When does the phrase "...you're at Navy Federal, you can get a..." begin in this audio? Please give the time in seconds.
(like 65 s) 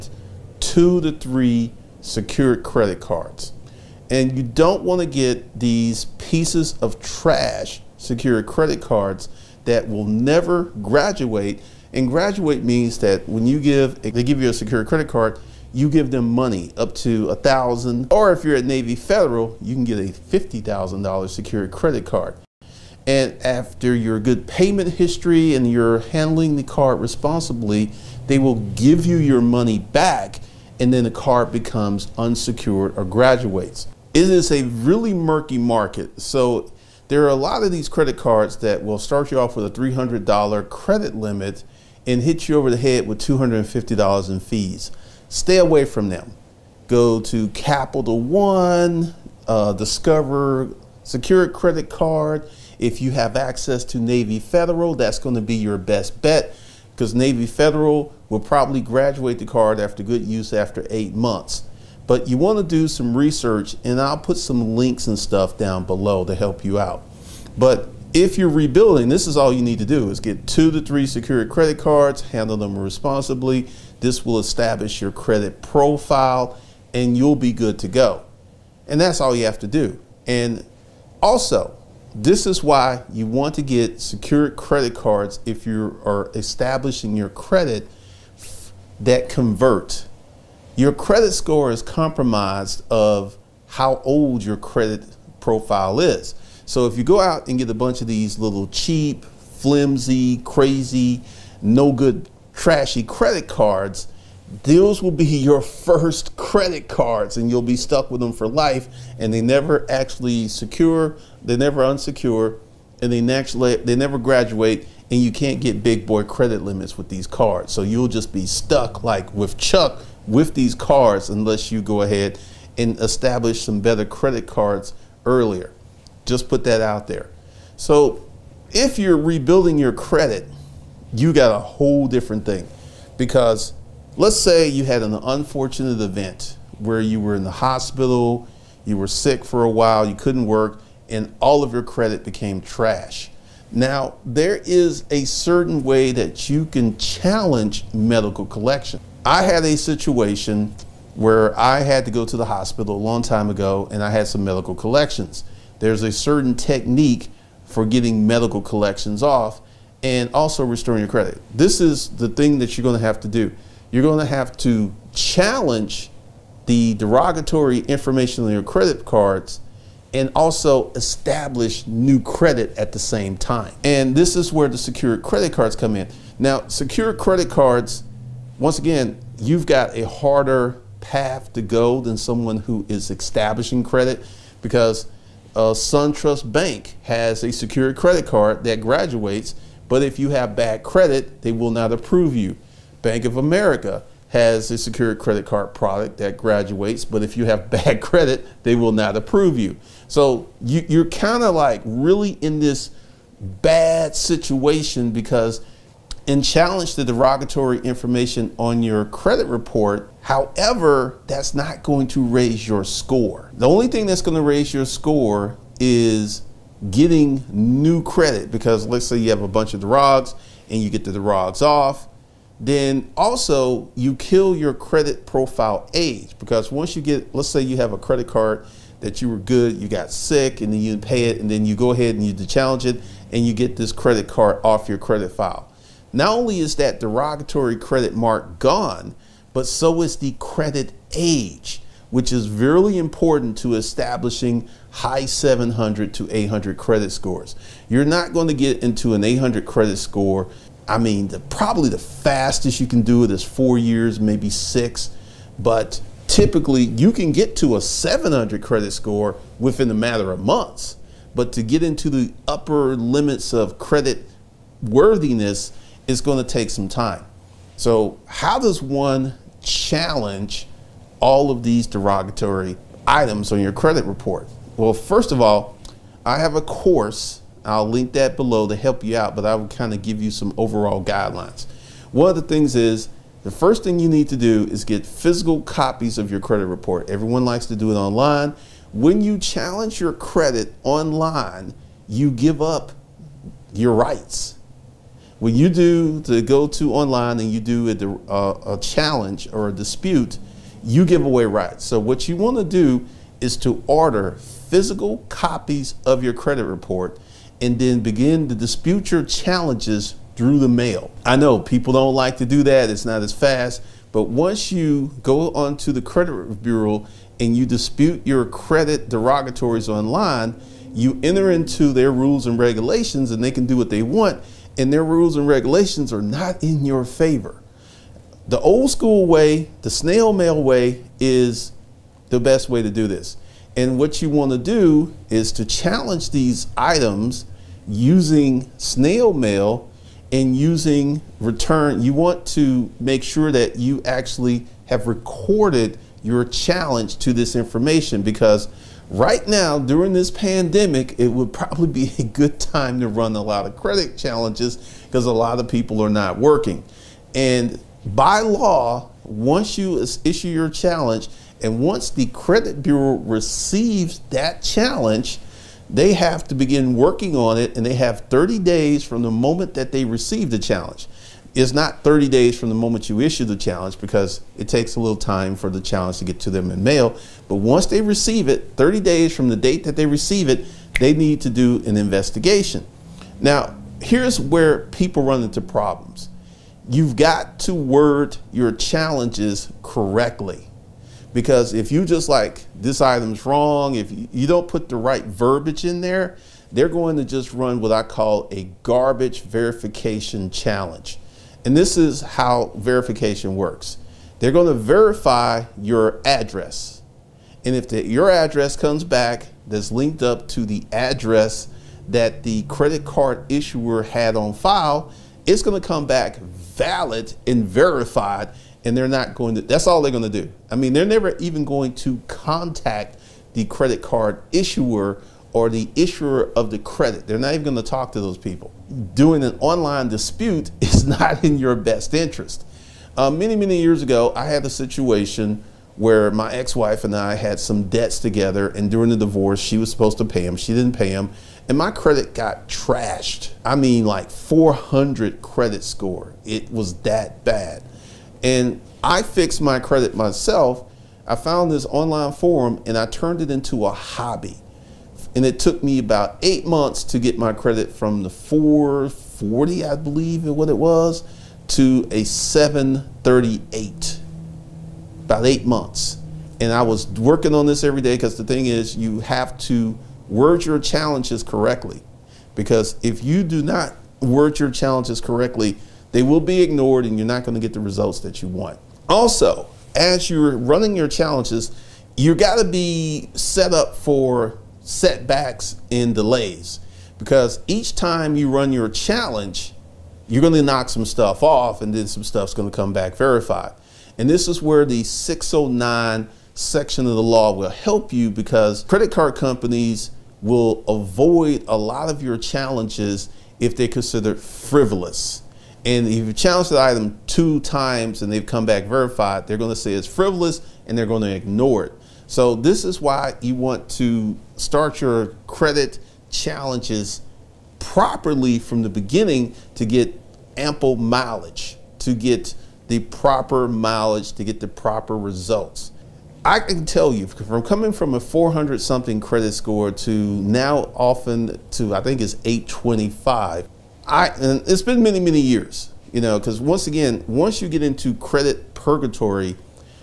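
18 s.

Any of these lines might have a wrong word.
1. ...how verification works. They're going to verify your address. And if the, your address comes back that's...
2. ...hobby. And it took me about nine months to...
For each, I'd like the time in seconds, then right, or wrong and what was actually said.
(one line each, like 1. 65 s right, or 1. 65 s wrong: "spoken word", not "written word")
1. 402 s right
2. 453 s wrong: "eight", not "nine".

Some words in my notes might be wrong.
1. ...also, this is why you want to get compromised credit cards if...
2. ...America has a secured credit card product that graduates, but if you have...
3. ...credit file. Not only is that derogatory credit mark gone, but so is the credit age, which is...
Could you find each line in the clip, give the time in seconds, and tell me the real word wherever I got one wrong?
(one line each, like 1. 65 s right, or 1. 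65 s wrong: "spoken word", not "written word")
1. 81 s wrong: "secured", not "compromised"
2. 193 s right
3. 234 s right.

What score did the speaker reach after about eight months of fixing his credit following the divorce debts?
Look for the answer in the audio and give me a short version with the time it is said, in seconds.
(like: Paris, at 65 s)
738, at 462 s.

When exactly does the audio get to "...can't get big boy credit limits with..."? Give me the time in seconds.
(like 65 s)
115 s.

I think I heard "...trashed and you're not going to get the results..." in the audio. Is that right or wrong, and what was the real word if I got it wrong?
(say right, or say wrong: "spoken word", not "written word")
wrong: "ignored", not "trashed".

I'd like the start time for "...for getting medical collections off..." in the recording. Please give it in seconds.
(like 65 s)
157 s.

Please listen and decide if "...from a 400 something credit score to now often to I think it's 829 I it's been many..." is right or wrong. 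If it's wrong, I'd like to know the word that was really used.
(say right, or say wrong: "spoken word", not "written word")
wrong: "825", not "829".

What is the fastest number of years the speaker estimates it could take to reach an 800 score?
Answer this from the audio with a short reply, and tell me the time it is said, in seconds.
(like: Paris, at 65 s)
4 years, at 253 s.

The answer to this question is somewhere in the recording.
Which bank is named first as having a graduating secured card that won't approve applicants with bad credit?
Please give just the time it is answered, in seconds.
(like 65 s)
185 s.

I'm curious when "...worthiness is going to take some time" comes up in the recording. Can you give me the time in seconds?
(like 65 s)
264 s.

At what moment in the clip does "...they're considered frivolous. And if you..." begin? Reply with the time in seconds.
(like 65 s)
503 s.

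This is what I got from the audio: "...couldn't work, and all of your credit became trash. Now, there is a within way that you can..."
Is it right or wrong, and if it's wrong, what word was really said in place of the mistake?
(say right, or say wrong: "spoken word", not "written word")
wrong: "certain", not "within".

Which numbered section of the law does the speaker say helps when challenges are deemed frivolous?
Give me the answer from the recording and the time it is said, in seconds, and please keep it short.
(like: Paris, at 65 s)
609, at 495 s.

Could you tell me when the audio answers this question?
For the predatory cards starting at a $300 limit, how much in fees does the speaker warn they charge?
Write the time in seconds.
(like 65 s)
43 s.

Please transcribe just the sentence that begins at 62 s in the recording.
But you want to do some research, and I'll put some links and stuff down below to help you out.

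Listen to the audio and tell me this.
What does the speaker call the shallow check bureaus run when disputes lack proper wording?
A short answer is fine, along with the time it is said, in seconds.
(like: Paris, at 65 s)
garbage verification challenge, at 398 s.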